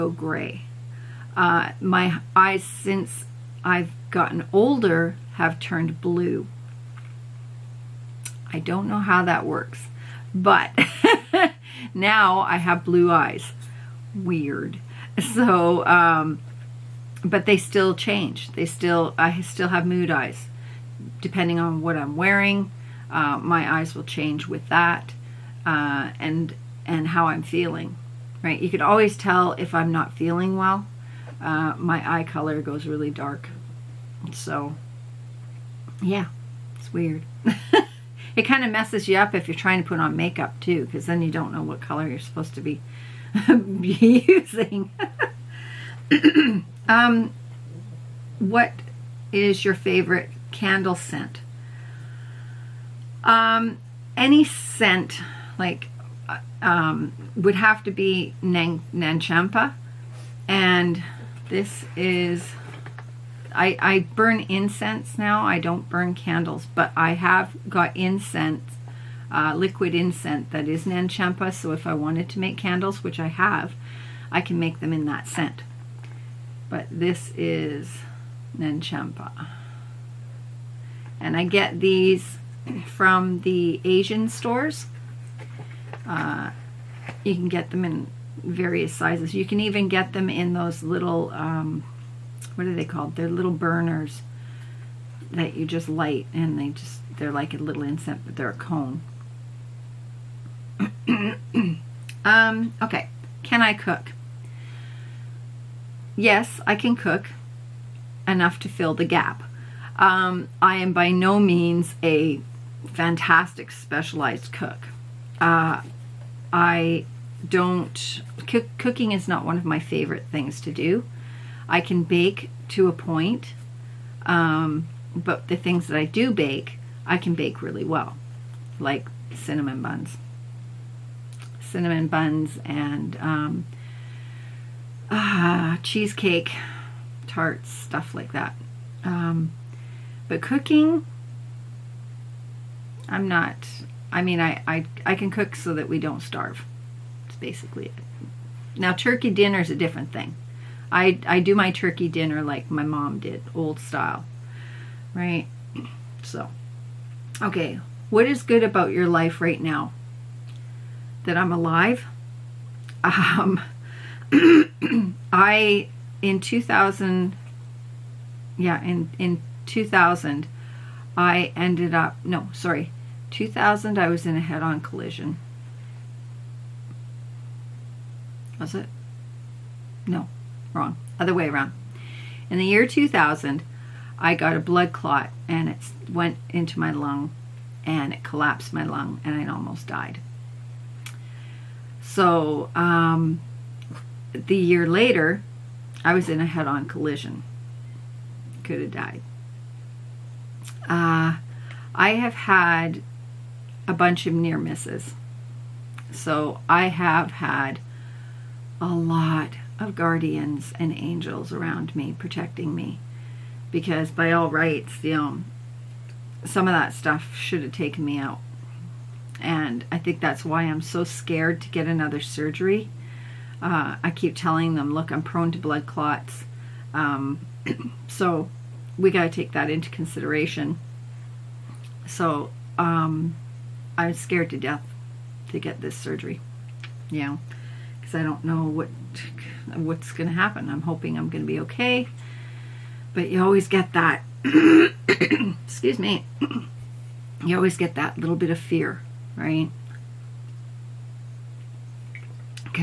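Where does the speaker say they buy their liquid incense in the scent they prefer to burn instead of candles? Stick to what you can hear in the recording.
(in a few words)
Asian stores.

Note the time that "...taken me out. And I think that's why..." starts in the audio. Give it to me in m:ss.
3:37.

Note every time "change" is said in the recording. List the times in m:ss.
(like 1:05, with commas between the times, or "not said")
0:17, 0:24.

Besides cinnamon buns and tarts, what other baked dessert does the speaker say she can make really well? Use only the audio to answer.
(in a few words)
Cheesecake.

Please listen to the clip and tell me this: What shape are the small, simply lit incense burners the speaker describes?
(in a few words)
Cone.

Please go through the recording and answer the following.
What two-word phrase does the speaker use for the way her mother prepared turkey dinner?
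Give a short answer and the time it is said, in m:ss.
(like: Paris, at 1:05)
Old style, at 2:33.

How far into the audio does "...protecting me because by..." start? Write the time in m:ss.
3:32.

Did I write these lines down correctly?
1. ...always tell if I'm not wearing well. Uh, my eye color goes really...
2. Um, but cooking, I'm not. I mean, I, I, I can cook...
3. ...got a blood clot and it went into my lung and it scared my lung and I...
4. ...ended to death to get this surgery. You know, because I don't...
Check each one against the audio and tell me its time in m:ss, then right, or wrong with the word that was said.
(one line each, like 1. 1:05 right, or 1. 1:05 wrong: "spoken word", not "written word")
1. 0:28 wrong: "feeling", not "wearing"
2. 2:19 right
3. 3:04 wrong: "collapsed", not "scared"
4. 3:54 wrong: "scared", not "ended".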